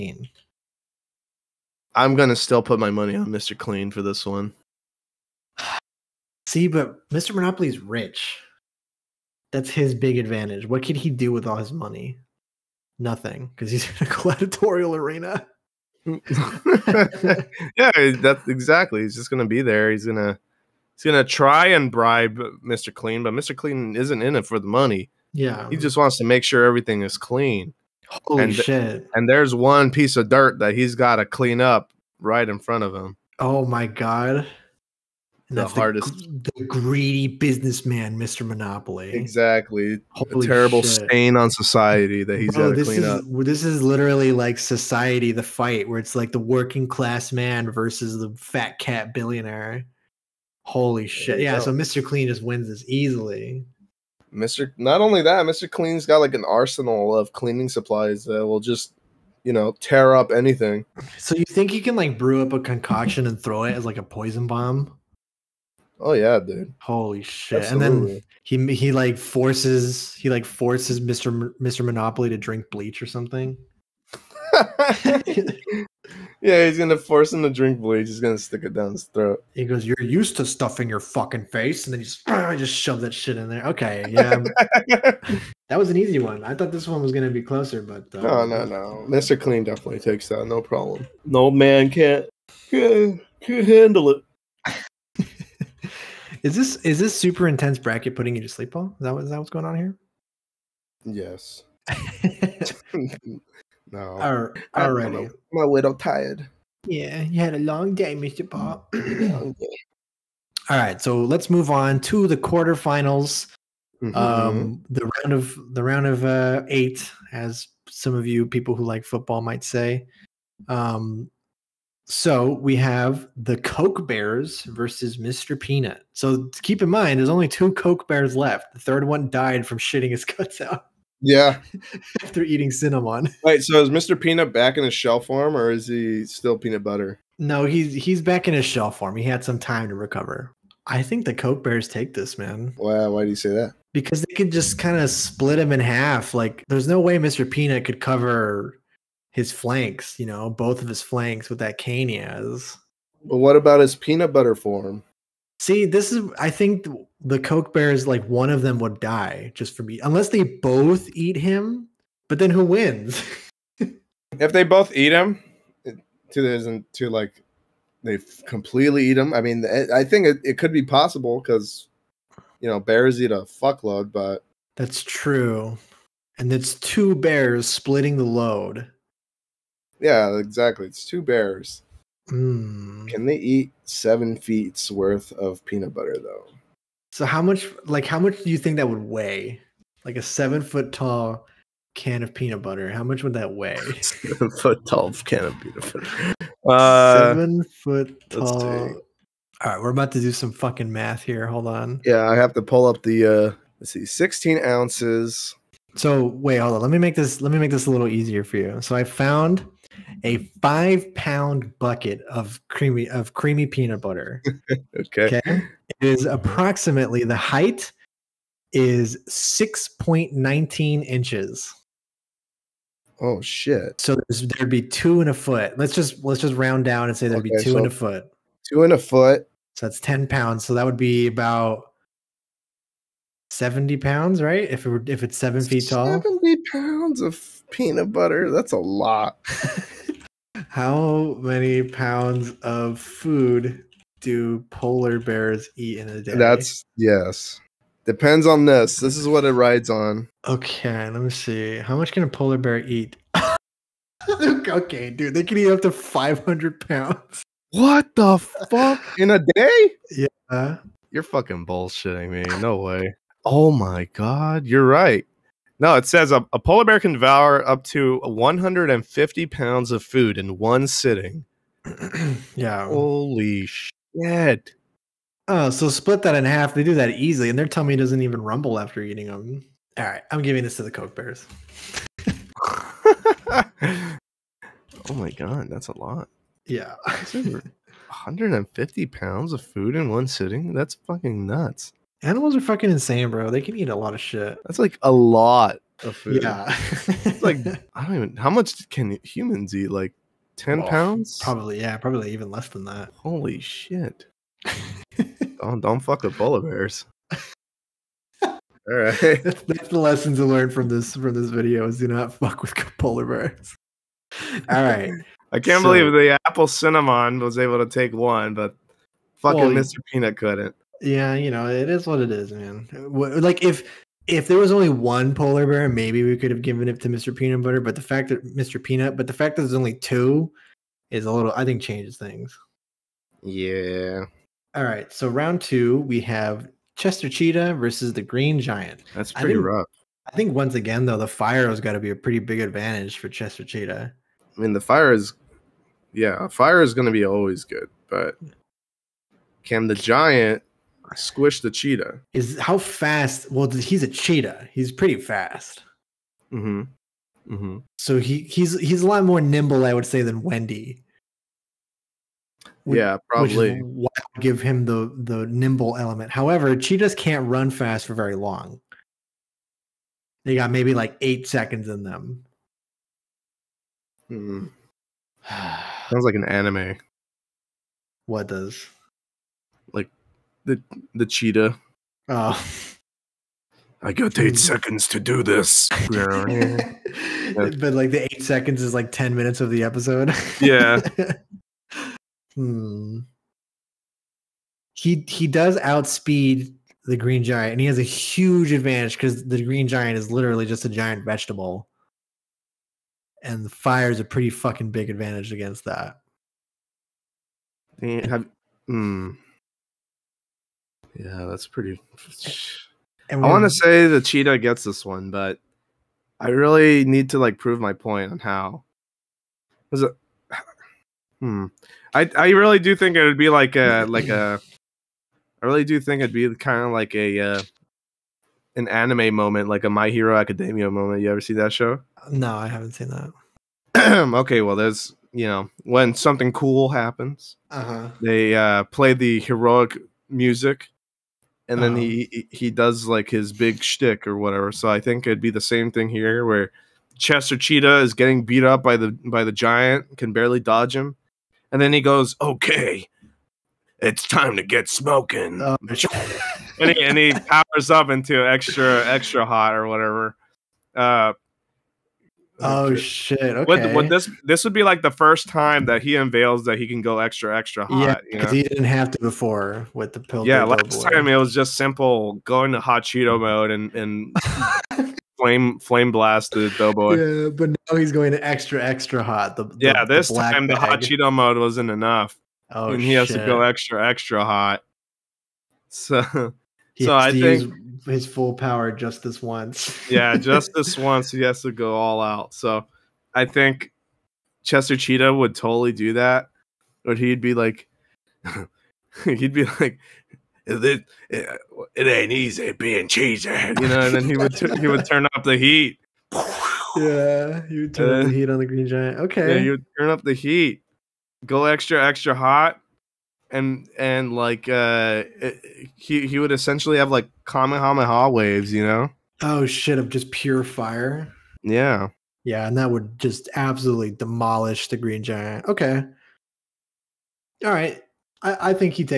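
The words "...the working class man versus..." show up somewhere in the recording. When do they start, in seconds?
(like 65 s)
46 s.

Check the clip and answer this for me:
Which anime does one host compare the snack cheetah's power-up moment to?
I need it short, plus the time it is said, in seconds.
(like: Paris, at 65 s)
My Hero Academia, at 429 s.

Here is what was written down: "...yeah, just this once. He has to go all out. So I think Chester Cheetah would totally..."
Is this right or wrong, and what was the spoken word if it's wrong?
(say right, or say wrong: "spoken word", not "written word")
right.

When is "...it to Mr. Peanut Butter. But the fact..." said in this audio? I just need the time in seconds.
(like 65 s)
326 s.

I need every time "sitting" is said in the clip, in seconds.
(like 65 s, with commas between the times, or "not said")
270 s, 290 s.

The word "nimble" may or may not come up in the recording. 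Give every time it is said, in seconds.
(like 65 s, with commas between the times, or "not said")
359 s, 365 s.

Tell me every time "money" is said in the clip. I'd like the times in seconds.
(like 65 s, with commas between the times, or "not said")
2 s, 11 s, 24 s.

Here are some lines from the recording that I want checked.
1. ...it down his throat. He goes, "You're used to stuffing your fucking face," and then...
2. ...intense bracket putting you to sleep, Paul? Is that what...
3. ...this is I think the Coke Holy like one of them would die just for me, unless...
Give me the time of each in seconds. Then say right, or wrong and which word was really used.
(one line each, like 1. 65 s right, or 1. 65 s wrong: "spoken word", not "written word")
1. 78 s right
2. 97 s right
3. 155 s wrong: "Bears", not "Holy".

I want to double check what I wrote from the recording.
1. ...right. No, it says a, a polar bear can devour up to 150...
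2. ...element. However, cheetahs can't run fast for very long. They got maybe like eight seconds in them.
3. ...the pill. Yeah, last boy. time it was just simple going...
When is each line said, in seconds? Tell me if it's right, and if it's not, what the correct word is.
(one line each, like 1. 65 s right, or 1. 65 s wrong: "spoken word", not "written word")
1. 264 s right
2. 365 s right
3. 470 s right.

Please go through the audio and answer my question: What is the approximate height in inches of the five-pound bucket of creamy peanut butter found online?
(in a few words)
6.19 inches.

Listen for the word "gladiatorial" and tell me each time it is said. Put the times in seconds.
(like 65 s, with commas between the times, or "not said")
14 s.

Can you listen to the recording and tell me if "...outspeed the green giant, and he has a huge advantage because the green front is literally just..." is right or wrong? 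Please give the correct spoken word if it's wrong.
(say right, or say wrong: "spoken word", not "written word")
wrong: "giant", not "front".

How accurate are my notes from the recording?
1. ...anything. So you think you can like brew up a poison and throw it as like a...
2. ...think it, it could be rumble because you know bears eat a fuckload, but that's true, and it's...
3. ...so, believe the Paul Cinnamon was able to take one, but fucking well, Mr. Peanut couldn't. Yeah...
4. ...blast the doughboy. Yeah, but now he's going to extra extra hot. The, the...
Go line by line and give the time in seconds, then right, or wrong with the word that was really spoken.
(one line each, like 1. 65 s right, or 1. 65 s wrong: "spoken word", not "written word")
1. 60 s wrong: "concoction", not "poison"
2. 170 s wrong: "possible", not "rumble"
3. 315 s wrong: "Apple", not "Paul"
4. 476 s right.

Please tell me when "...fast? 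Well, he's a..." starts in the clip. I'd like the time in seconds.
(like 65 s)
352 s.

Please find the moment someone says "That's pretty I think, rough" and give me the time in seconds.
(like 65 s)
339 s.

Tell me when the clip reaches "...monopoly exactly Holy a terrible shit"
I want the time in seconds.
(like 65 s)
38 s.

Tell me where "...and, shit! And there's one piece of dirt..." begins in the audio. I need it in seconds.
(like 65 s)
28 s.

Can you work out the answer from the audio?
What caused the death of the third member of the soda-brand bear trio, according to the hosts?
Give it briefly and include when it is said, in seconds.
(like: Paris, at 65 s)
Eating cinnamon, at 132 s.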